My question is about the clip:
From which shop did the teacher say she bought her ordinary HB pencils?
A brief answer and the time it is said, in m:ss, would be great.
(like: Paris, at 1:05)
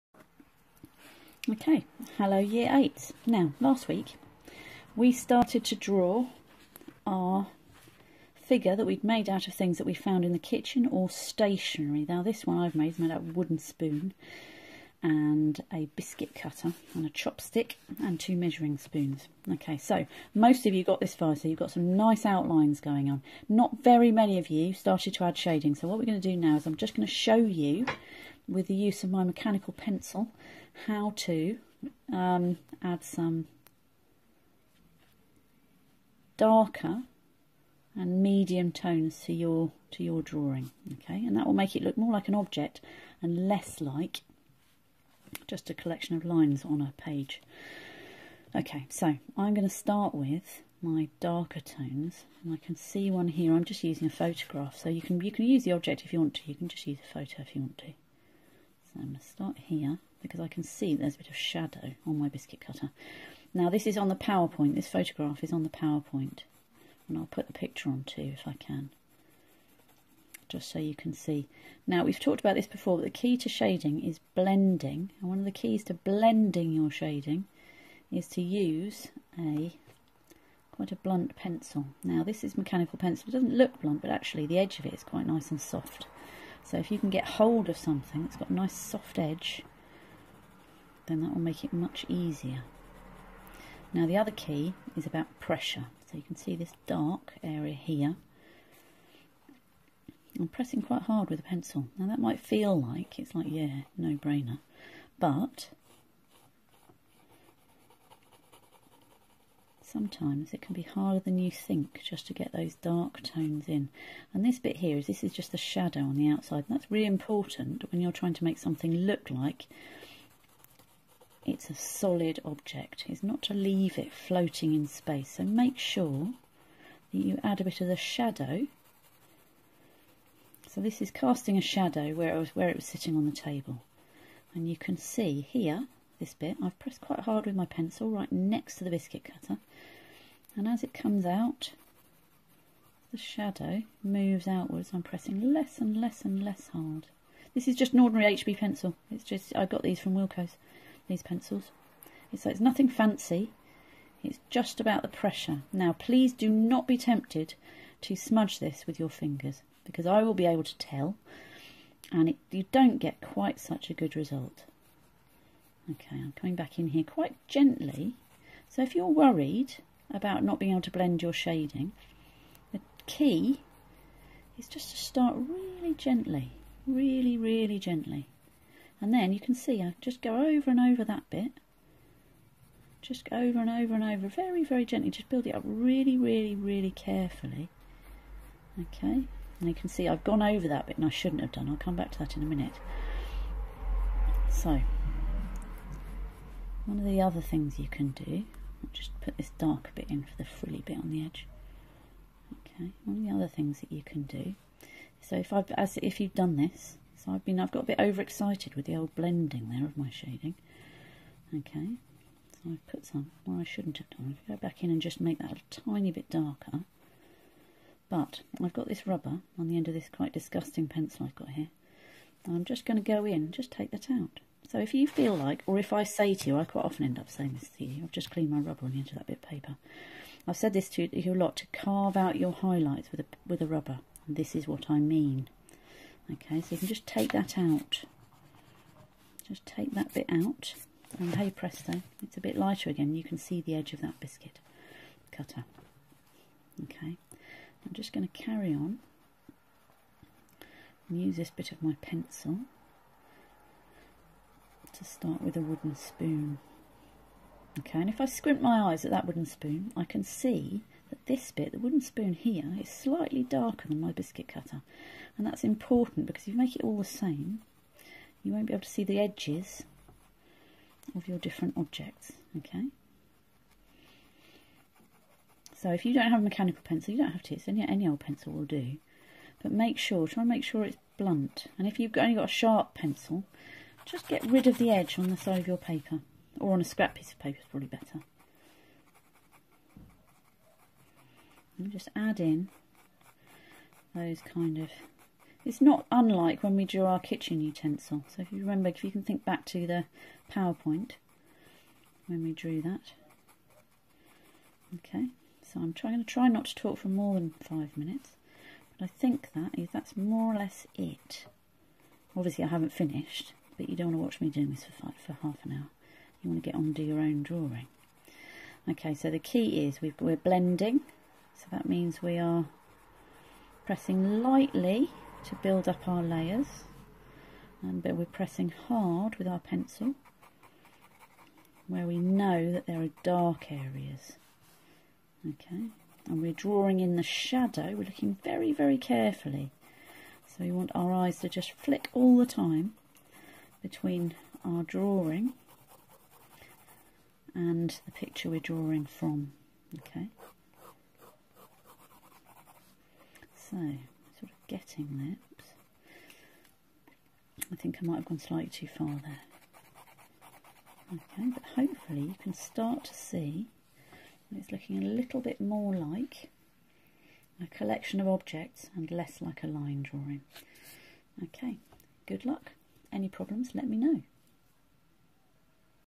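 Wilko's, at 2:30.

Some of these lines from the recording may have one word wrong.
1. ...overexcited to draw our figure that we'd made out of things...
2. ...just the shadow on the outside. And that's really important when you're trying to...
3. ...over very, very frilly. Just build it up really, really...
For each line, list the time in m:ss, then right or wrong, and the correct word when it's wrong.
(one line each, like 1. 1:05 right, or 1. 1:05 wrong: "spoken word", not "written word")
1. 0:05 wrong: "started", not "overexcited"
2. 1:55 right
3. 3:04 wrong: "gently", not "frilly".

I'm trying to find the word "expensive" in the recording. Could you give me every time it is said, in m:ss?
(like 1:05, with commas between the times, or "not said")
not said.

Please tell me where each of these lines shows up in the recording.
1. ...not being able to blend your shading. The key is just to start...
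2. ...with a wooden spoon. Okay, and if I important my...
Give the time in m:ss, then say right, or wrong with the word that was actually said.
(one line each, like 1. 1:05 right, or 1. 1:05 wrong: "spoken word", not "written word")
1. 2:50 right
2. 4:15 wrong: "squint", not "important".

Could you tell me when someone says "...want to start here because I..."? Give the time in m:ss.
0:57.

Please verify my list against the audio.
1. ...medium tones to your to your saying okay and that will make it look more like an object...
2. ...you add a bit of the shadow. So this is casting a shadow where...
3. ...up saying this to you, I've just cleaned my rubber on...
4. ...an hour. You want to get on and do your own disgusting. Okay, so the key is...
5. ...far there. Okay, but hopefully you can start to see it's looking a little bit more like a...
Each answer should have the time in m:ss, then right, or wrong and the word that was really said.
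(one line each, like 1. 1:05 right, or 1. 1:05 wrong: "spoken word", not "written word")
1. 0:38 wrong: "drawing", not "saying"
2. 2:07 right
3. 3:47 right
4. 5:15 wrong: "drawing", not "disgusting"
5. 5:58 right.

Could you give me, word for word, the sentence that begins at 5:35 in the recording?
Okay, and we're drawing in the shadow, we're looking very, very carefully.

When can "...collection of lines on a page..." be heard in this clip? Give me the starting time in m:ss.
0:45.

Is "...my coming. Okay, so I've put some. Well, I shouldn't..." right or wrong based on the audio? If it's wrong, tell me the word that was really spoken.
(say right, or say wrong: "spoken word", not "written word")
wrong: "shading", not "coming".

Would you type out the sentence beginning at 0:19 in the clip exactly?
Okay, so most of you got this far, so you've got some nice outlines going on.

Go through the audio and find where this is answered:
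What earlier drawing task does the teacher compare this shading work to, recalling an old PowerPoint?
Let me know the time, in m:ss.
4:57.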